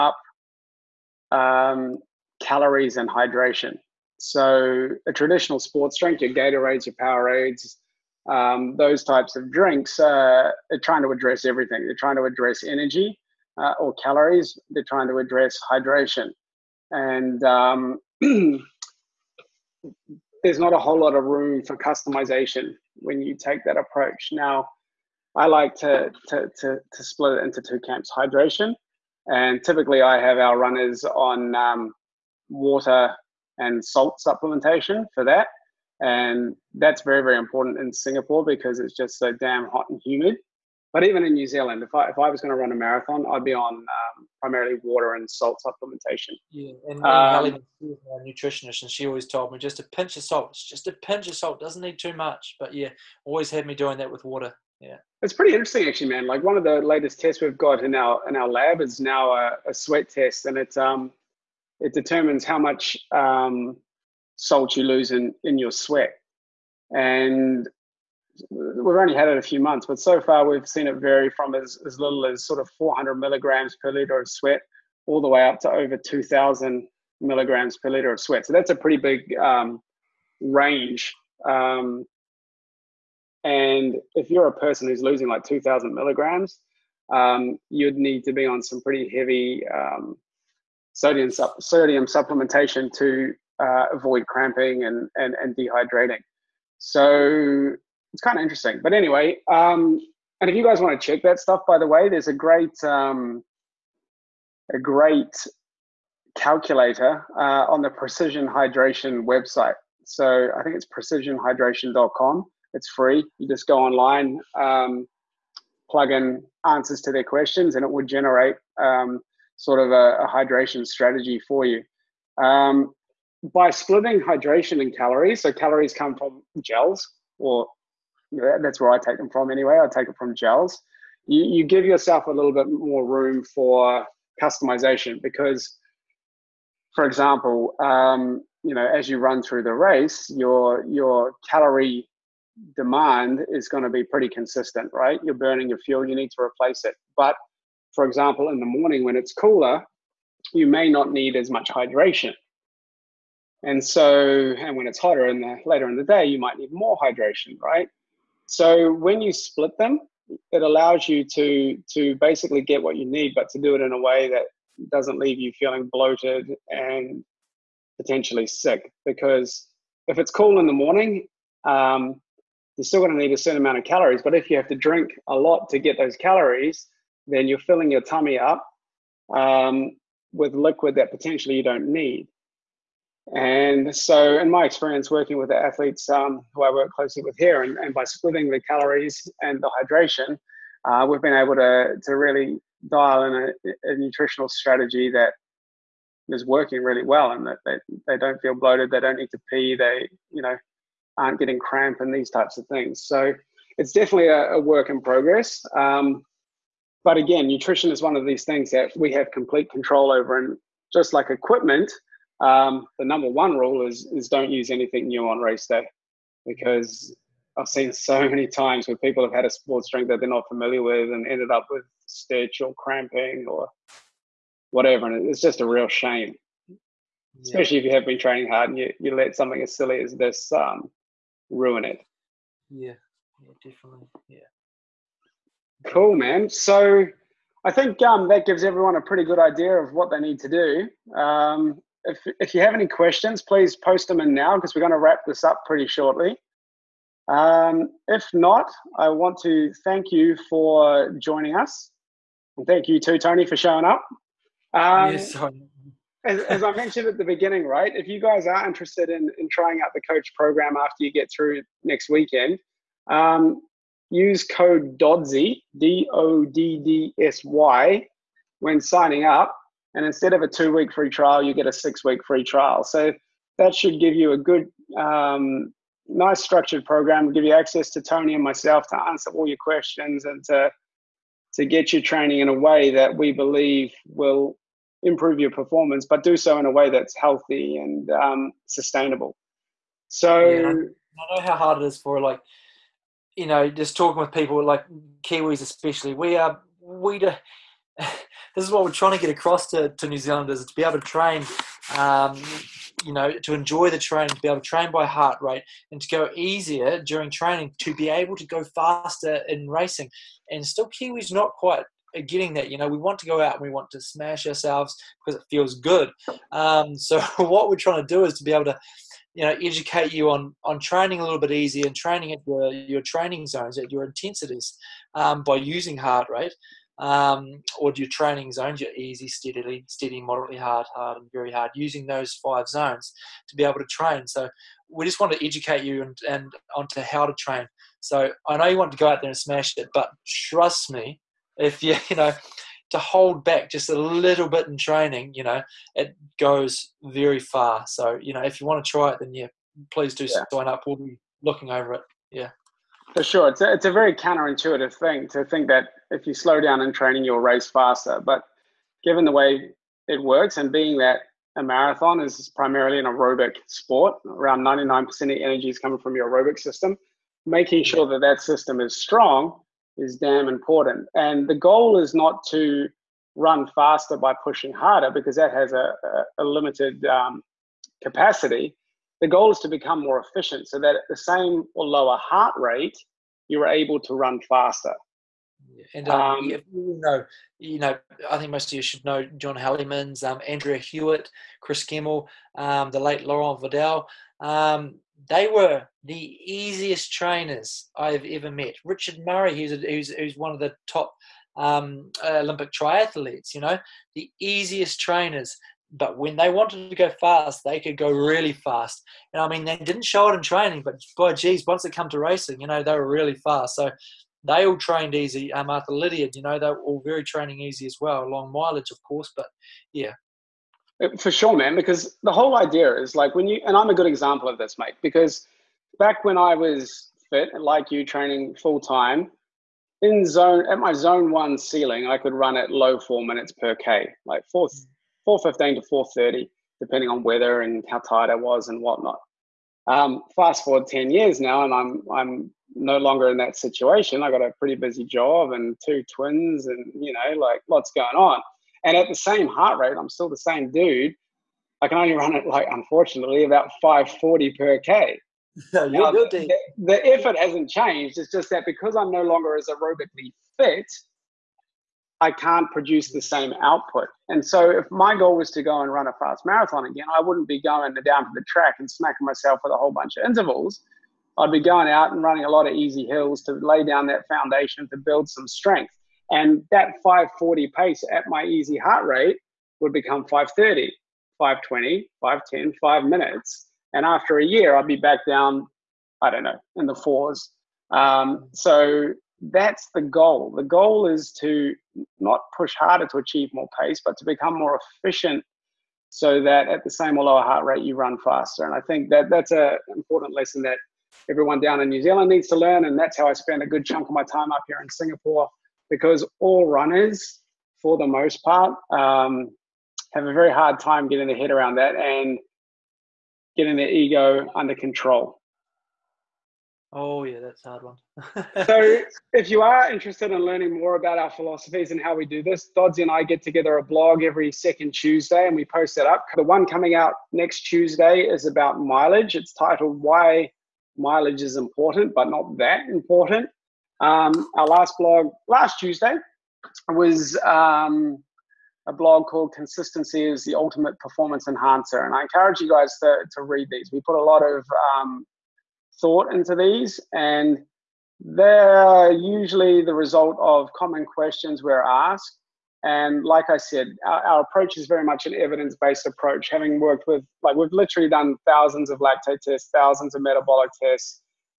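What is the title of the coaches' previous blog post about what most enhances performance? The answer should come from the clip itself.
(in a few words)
Consistency is the Ultimate Performance Enhancer.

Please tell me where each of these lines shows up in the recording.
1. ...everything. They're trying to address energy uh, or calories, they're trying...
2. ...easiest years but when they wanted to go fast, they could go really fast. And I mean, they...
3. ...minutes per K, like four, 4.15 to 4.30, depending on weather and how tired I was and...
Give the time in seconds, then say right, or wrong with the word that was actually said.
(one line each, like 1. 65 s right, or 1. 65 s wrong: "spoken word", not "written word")
1. 11 s right
2. 404 s wrong: "trainers", not "years"
3. 433 s right.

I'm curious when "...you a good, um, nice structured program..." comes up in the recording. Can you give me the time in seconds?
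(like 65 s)
274 s.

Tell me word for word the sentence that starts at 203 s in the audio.
So, it's definitely a, a work in progress.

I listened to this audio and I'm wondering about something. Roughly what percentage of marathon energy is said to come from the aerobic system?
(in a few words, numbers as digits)
99%.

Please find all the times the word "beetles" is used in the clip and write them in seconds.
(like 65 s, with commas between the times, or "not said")
not said.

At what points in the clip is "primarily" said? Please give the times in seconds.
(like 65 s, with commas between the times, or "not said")
44 s, 362 s.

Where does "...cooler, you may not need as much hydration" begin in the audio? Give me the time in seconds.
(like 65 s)
149 s.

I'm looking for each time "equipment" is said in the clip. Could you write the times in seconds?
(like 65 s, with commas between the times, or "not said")
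211 s.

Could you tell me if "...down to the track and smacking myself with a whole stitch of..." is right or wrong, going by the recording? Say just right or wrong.
wrong.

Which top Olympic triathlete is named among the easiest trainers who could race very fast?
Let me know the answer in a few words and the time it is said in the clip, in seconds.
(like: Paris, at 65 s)
Richard Murray, at 398 s.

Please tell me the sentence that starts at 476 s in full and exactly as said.
And that 540 pace at my easy heart rate would become 530, 520, 510, five minutes.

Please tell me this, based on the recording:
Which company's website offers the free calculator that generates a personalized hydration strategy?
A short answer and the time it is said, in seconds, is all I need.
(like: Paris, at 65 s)
Precision Hydration, at 107 s.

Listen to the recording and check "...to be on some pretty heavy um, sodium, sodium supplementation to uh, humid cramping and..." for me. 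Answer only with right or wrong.
wrong.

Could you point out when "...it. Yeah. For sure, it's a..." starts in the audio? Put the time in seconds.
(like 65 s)
351 s.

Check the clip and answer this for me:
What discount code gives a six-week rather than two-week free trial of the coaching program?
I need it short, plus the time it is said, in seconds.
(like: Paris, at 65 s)
DODDSY, at 264 s.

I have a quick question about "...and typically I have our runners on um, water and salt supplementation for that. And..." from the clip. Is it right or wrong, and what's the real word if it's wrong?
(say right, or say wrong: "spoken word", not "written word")
right.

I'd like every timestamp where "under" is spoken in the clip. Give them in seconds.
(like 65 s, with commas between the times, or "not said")
514 s.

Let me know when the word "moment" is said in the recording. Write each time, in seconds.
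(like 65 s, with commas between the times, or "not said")
not said.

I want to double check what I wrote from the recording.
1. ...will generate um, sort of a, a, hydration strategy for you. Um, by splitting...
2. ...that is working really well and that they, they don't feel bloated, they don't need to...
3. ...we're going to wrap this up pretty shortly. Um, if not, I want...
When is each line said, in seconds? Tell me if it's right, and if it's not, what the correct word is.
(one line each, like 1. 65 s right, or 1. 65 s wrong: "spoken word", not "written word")
1. 117 s right
2. 195 s right
3. 244 s right.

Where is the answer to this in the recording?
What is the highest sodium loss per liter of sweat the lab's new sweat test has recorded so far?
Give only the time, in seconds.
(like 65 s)
75 s.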